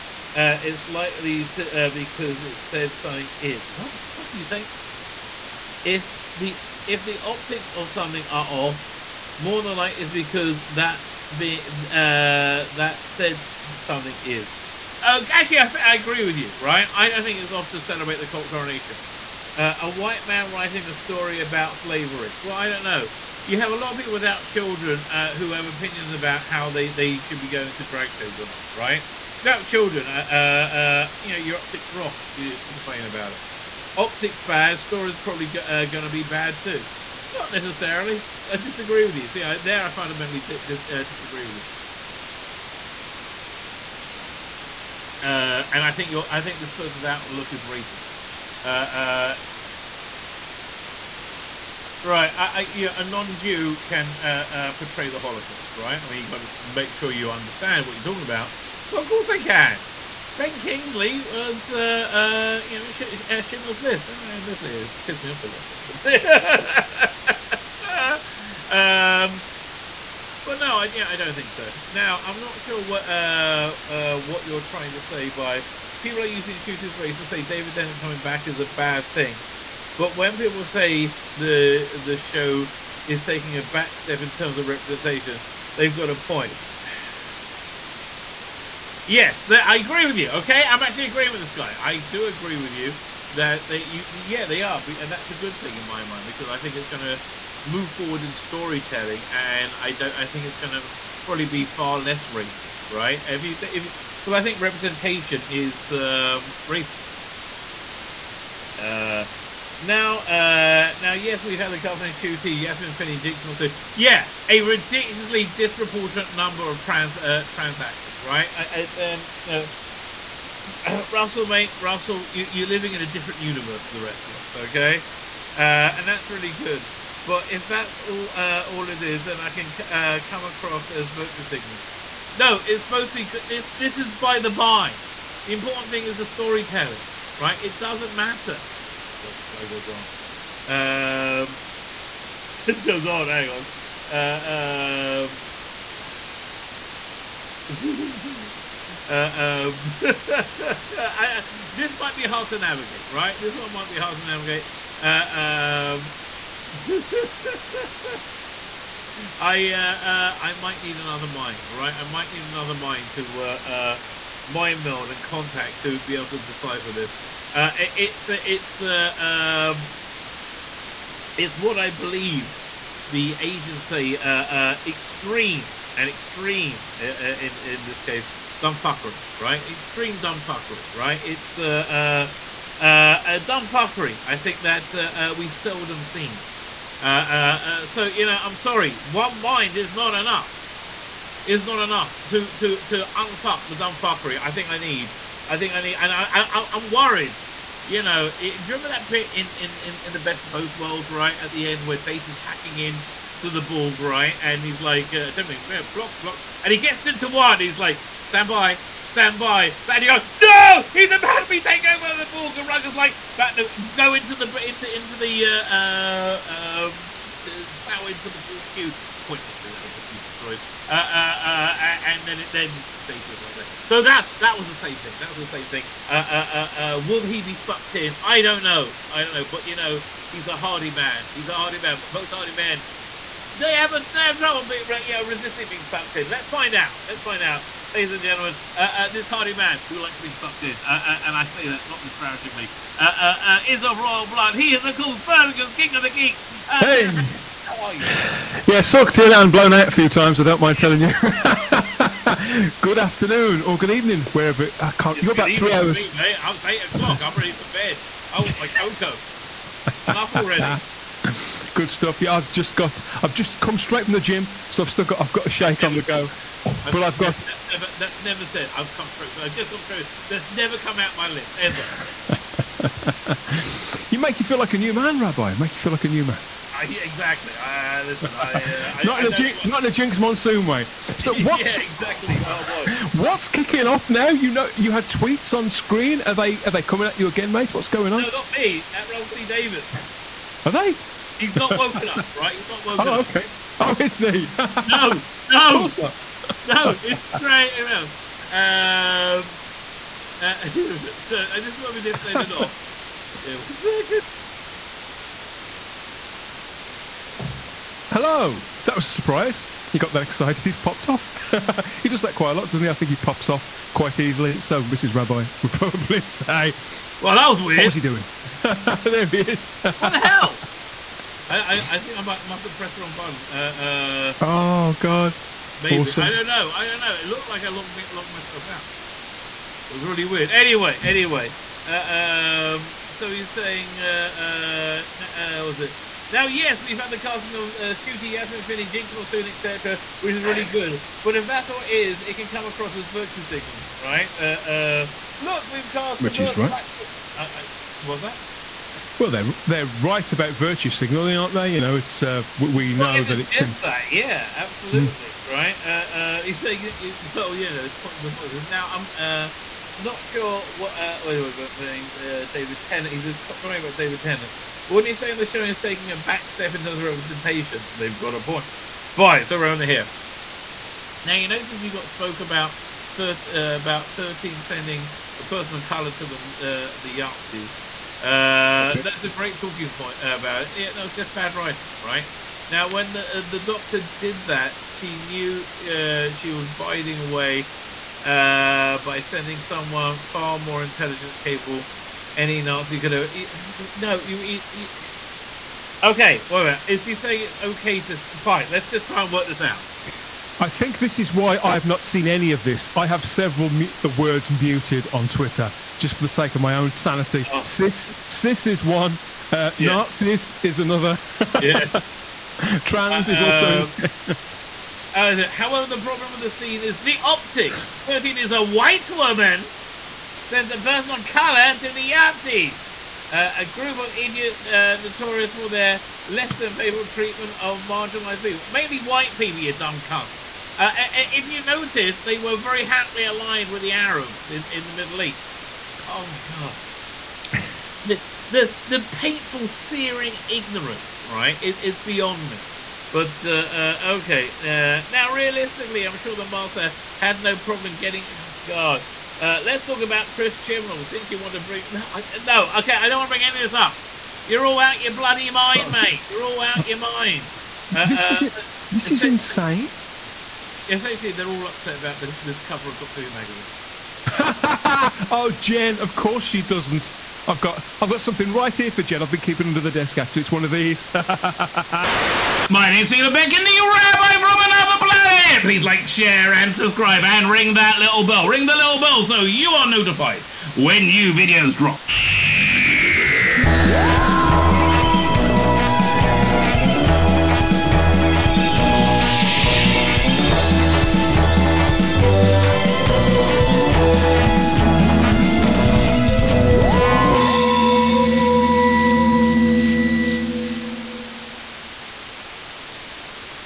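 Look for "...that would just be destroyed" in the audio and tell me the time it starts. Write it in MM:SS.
03:39.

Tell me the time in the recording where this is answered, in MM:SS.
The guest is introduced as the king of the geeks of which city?
04:05.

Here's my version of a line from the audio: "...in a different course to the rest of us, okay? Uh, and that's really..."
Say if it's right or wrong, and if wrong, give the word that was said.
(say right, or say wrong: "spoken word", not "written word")
wrong: "universe", not "course".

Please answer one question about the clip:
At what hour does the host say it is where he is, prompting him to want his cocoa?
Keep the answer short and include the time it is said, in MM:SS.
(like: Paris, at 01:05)
8 o'clock, at 04:16.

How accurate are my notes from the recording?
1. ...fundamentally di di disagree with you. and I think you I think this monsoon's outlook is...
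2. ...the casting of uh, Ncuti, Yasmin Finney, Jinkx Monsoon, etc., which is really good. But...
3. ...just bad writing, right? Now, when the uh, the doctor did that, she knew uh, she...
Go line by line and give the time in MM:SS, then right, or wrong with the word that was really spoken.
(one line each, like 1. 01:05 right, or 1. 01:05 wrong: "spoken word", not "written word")
1. 00:39 wrong: "person", not "monsoon"
2. 05:37 right
3. 06:21 right.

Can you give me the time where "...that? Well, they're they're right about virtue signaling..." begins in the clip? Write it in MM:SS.
05:48.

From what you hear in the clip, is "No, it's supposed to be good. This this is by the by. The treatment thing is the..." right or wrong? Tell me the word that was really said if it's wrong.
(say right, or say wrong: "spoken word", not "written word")
wrong: "important", not "treatment".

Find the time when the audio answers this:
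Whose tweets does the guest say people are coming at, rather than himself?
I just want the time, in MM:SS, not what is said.
04:49.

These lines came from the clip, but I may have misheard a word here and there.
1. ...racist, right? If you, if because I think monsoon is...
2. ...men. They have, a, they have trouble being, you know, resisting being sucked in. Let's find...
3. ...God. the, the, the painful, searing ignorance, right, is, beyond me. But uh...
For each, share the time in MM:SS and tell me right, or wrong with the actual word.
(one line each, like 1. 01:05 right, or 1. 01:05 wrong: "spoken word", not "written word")
1. 01:42 wrong: "representation", not "monsoon"
2. 03:52 right
3. 07:16 right.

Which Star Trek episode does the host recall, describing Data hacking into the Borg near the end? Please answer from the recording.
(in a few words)
The Best of Both Worlds.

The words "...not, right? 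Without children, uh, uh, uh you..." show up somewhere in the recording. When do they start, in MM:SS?
00:28.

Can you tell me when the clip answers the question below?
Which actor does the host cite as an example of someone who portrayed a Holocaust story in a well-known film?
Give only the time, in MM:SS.
01:00.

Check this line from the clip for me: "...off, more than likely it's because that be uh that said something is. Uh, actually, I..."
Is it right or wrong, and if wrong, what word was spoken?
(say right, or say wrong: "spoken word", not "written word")
right.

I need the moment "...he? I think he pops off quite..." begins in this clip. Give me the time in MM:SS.
05:12.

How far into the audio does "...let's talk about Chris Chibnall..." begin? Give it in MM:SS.
07:29.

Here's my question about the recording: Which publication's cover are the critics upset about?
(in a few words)
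Doctor Who magazine.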